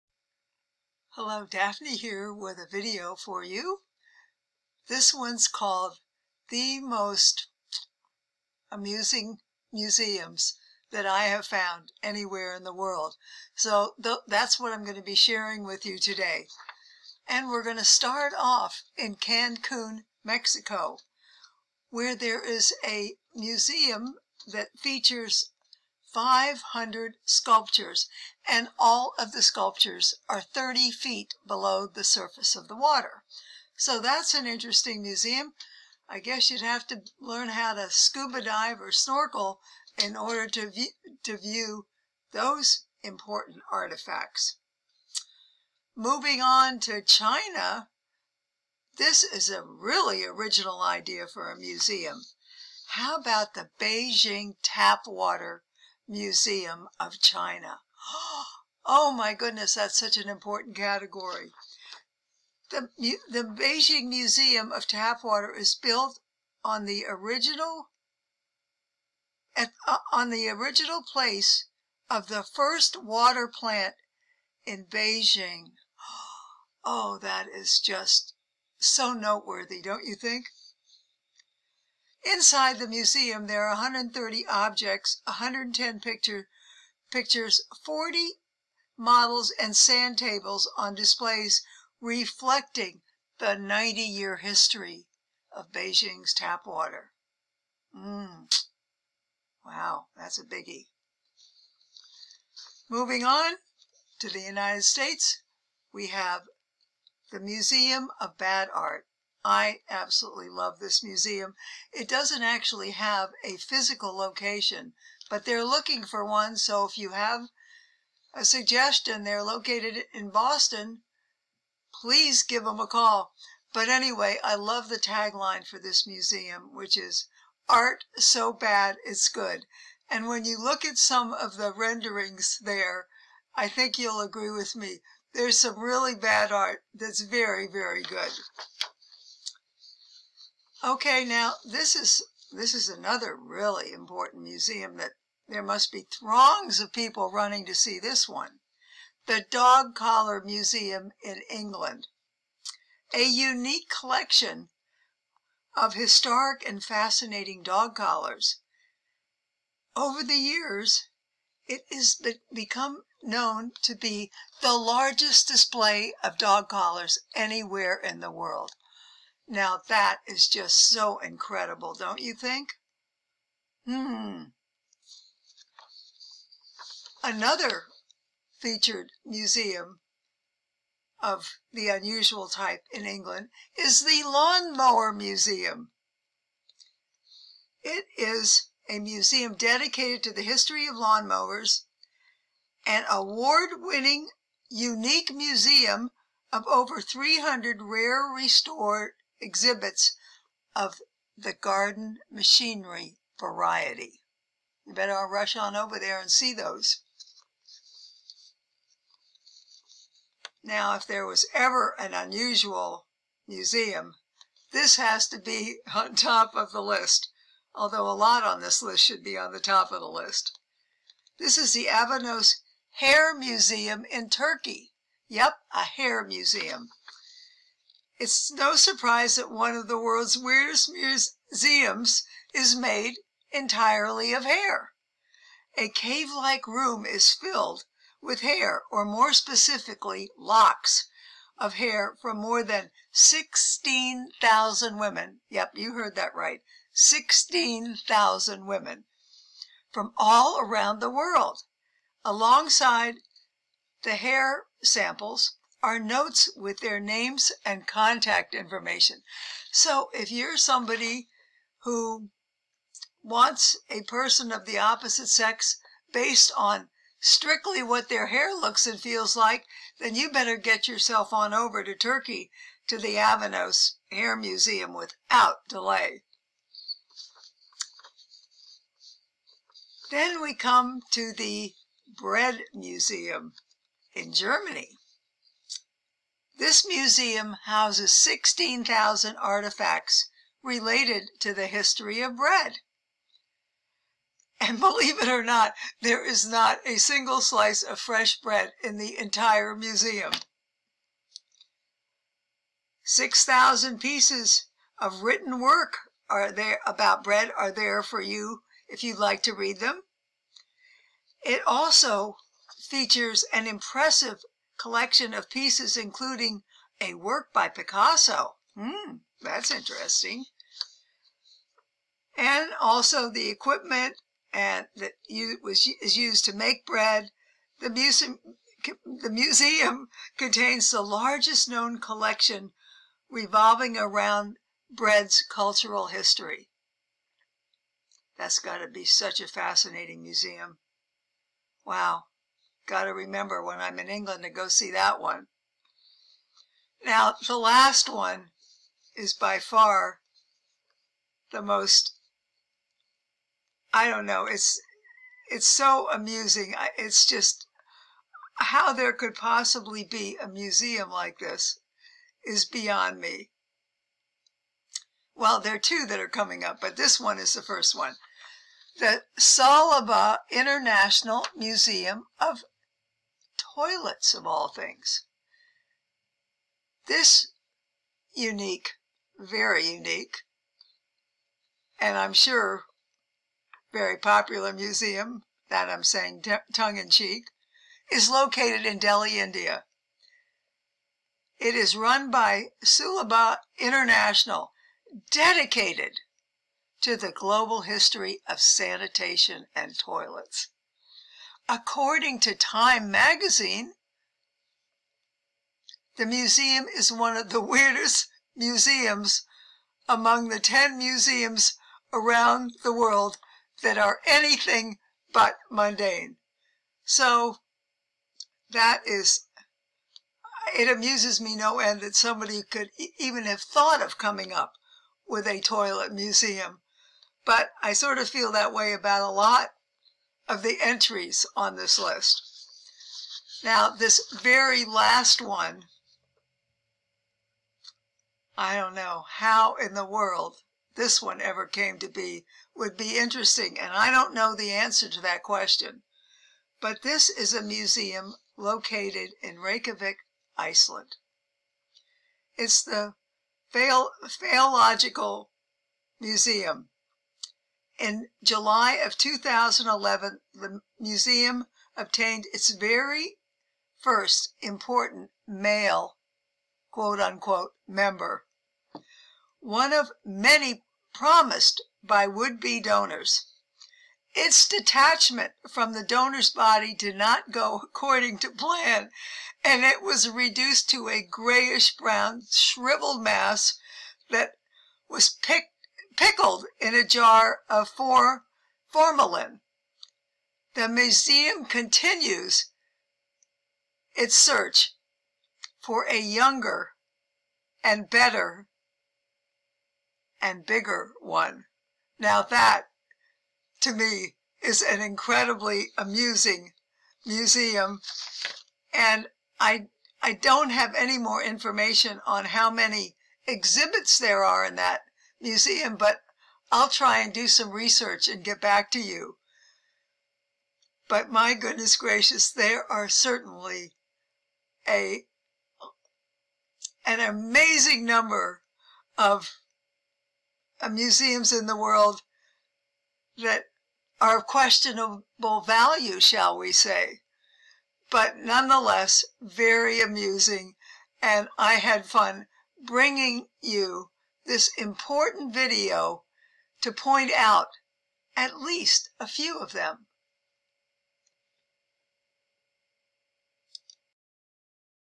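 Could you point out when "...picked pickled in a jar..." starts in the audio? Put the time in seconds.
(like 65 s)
485 s.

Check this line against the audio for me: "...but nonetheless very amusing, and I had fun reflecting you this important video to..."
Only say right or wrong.
wrong.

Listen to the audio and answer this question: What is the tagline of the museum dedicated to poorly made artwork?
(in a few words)
Art so bad it's good.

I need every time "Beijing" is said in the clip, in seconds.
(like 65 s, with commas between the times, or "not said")
53 s, 63 s, 74 s, 95 s.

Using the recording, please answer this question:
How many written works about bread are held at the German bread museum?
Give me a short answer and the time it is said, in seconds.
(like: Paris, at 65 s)
6,000, at 303 s.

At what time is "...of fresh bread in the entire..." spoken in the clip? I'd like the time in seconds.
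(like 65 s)
297 s.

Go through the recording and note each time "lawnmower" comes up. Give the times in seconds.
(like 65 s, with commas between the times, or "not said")
184 s, 190 s.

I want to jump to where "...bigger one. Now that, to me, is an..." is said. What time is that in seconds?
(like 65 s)
500 s.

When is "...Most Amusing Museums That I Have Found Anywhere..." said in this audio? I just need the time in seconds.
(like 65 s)
6 s.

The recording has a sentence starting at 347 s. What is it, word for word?
Now, the last one is by far the most, I don't know, it's, it's so amusing.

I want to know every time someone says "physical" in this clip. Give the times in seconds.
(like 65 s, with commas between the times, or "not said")
113 s.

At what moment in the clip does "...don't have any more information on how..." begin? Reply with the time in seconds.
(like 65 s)
510 s.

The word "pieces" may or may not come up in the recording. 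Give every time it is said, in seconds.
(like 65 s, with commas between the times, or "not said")
303 s, 315 s.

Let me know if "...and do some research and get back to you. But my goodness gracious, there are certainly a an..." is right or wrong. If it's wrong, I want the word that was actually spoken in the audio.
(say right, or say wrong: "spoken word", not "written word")
right.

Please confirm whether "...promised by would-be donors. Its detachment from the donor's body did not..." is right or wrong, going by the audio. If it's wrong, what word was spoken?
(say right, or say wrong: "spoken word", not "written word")
right.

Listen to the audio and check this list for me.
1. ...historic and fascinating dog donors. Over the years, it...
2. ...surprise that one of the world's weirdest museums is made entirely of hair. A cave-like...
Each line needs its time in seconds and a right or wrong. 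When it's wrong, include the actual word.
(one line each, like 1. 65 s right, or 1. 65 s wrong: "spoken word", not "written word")
1. 155 s wrong: "collars", not "donors"
2. 228 s right.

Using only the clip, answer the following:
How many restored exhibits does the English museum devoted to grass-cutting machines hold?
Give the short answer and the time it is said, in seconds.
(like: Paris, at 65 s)
over 300, at 196 s.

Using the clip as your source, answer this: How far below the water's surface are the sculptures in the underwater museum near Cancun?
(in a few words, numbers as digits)
30 feet.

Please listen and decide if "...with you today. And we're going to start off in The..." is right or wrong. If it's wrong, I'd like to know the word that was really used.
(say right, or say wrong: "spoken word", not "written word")
wrong: "Cancun", not "The".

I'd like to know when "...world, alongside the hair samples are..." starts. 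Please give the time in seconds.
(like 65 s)
251 s.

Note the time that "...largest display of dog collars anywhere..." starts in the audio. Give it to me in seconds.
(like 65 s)
164 s.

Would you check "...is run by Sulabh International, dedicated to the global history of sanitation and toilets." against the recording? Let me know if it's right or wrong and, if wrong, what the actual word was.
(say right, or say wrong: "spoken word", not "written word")
right.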